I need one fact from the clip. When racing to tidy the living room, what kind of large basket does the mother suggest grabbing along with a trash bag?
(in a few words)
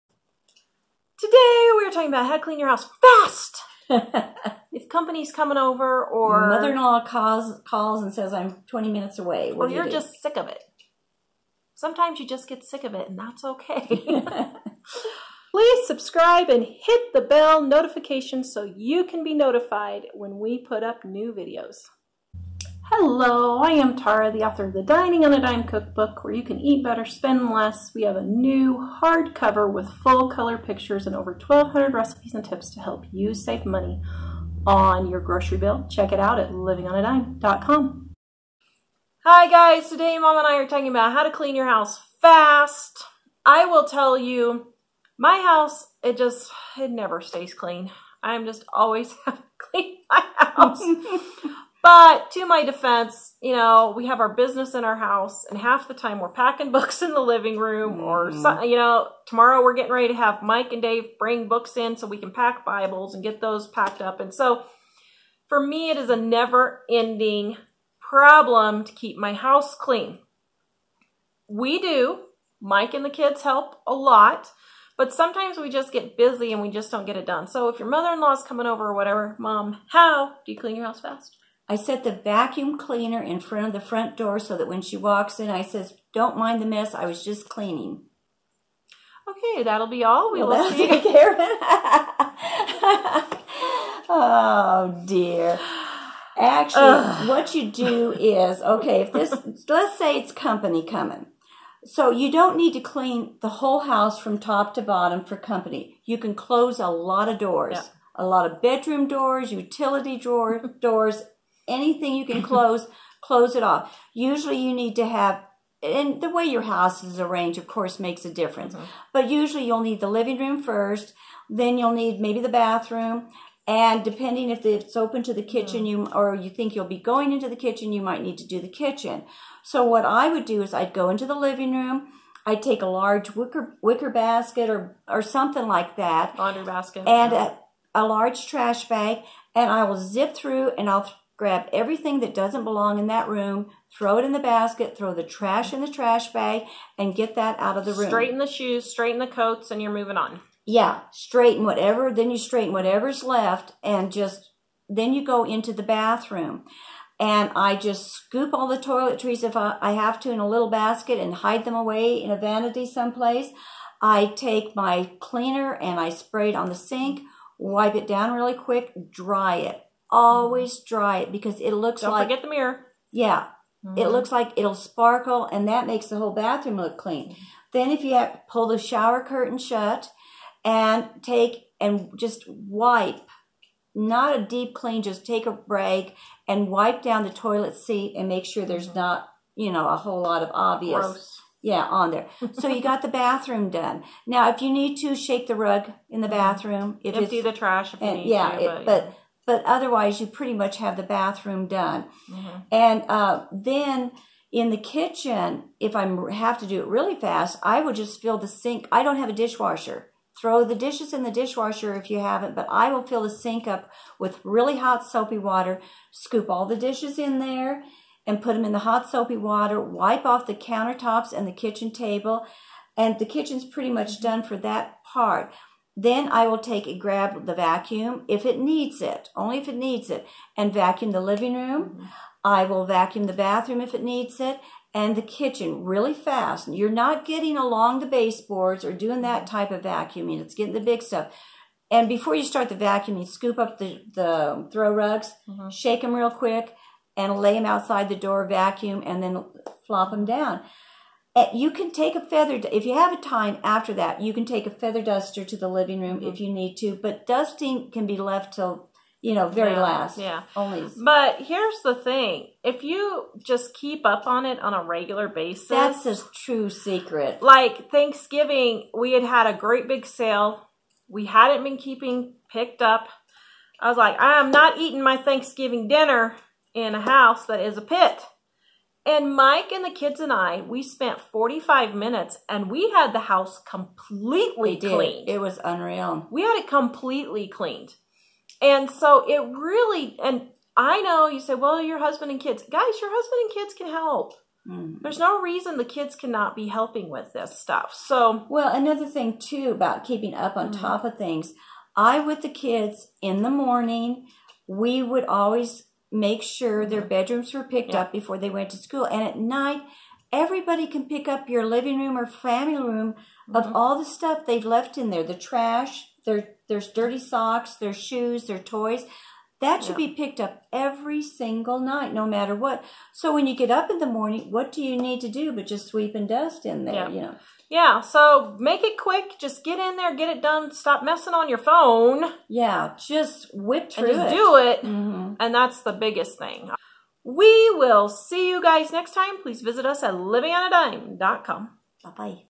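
wicker basket.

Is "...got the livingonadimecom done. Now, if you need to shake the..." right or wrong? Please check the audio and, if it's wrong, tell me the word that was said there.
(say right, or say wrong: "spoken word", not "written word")
wrong: "bathroom", not "livingonadimecom".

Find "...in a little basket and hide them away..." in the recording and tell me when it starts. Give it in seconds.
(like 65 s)
160 s.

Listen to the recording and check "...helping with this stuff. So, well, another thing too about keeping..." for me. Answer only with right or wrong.
right.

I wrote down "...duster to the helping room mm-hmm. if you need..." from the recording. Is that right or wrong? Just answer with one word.
wrong.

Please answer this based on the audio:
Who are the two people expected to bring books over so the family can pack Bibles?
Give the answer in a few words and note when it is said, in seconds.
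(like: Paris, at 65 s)
Mike and Dave, at 60 s.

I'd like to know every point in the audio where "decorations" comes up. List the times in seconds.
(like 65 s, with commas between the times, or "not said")
not said.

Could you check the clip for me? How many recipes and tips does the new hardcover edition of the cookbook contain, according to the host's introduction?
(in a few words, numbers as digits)
over 1,200.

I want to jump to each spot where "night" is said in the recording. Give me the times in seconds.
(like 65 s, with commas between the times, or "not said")
309 s, 321 s.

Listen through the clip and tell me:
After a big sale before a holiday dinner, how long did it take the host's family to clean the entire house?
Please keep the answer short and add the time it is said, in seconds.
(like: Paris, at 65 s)
45 minutes, at 281 s.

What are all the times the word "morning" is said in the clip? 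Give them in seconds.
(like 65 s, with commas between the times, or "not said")
303 s, 324 s.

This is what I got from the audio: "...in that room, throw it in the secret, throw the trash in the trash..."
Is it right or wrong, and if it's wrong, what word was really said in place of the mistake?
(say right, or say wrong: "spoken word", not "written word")
wrong: "basket", not "secret".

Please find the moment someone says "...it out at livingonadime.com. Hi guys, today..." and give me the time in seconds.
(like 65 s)
36 s.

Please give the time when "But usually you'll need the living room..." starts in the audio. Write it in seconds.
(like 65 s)
119 s.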